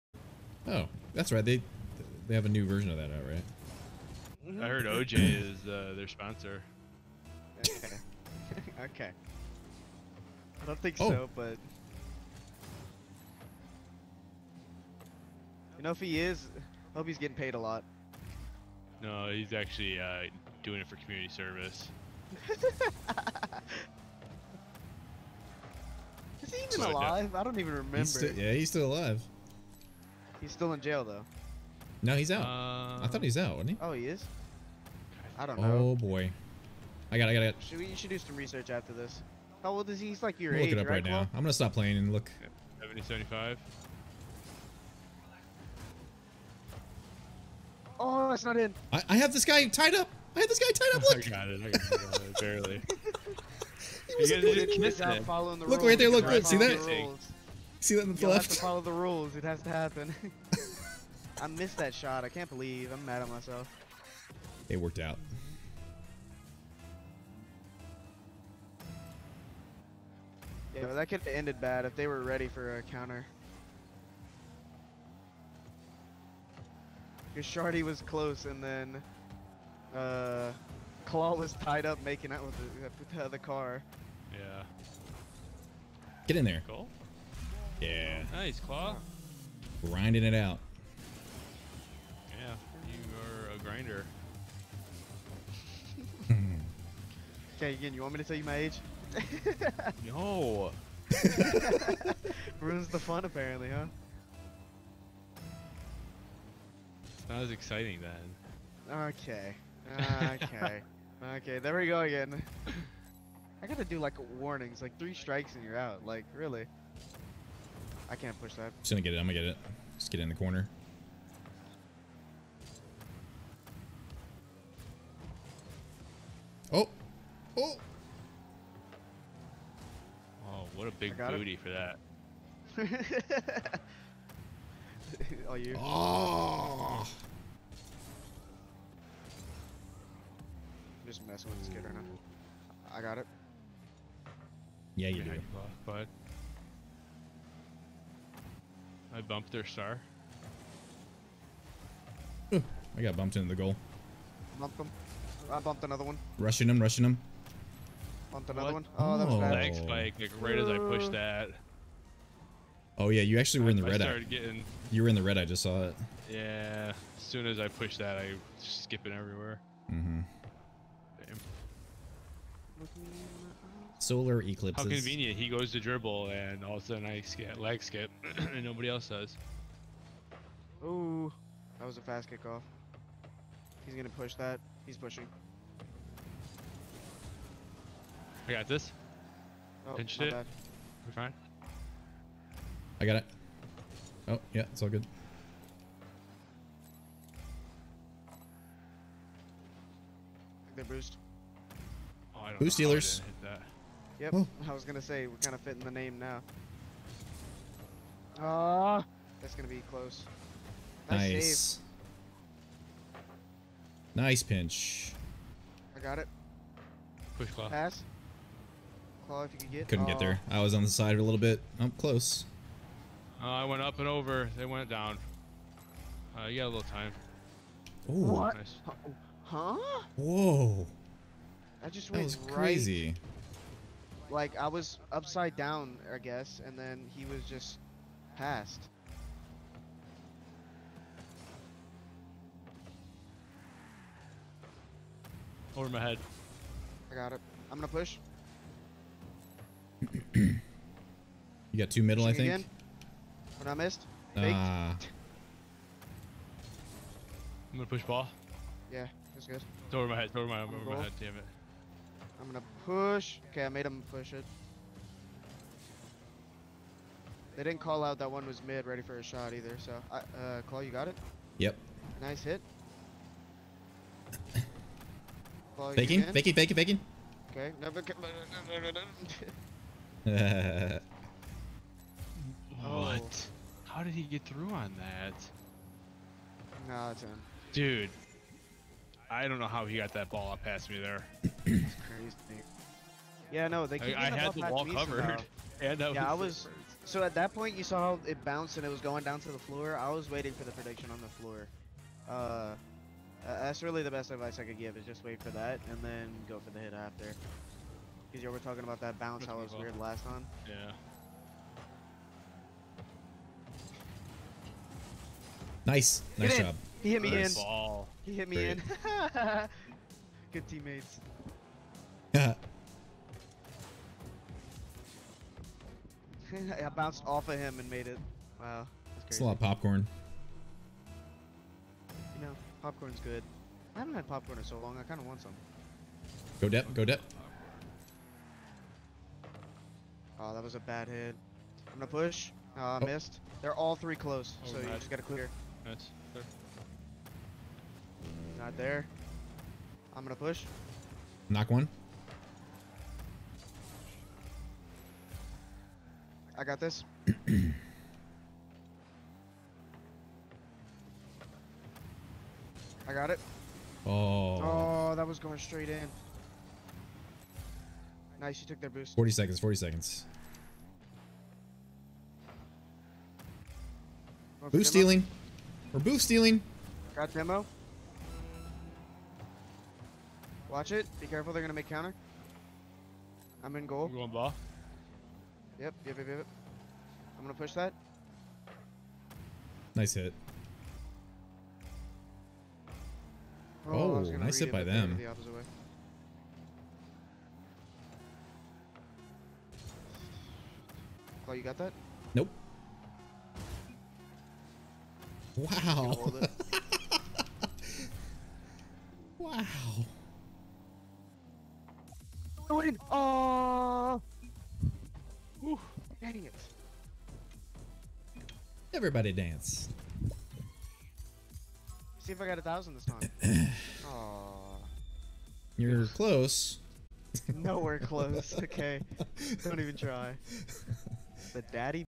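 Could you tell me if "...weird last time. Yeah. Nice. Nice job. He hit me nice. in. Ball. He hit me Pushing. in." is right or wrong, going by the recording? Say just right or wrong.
wrong.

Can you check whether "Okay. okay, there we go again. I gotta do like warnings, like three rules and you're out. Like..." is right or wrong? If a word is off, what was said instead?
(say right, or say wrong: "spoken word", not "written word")
wrong: "strikes", not "rules".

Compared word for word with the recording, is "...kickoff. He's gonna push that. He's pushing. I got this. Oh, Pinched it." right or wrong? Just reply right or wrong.
right.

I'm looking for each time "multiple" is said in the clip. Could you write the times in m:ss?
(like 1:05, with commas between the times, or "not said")
not said.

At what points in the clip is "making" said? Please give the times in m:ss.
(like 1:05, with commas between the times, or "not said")
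1:22.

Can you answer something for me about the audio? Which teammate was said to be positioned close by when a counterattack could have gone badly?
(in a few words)
Shardy.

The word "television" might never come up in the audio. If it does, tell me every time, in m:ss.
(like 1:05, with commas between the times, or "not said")
not said.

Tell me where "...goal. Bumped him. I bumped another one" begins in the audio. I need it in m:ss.
2:33.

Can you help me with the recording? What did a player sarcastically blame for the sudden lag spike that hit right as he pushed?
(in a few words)
solar eclipses.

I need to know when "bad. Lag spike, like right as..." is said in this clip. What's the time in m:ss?
2:39.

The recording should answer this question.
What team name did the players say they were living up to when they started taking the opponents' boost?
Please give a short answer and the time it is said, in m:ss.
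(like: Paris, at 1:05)
Boost dealers, at 3:22.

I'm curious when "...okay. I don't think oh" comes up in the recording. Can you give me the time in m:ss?
0:08.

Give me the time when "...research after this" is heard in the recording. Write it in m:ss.
0:38.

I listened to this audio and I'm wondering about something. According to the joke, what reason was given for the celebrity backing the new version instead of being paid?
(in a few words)
community service.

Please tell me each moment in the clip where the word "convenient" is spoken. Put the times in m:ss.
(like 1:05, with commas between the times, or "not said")
2:54.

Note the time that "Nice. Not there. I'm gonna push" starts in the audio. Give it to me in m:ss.
5:45.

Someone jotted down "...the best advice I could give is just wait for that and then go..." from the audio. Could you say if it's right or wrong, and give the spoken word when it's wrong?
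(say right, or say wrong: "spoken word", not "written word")
right.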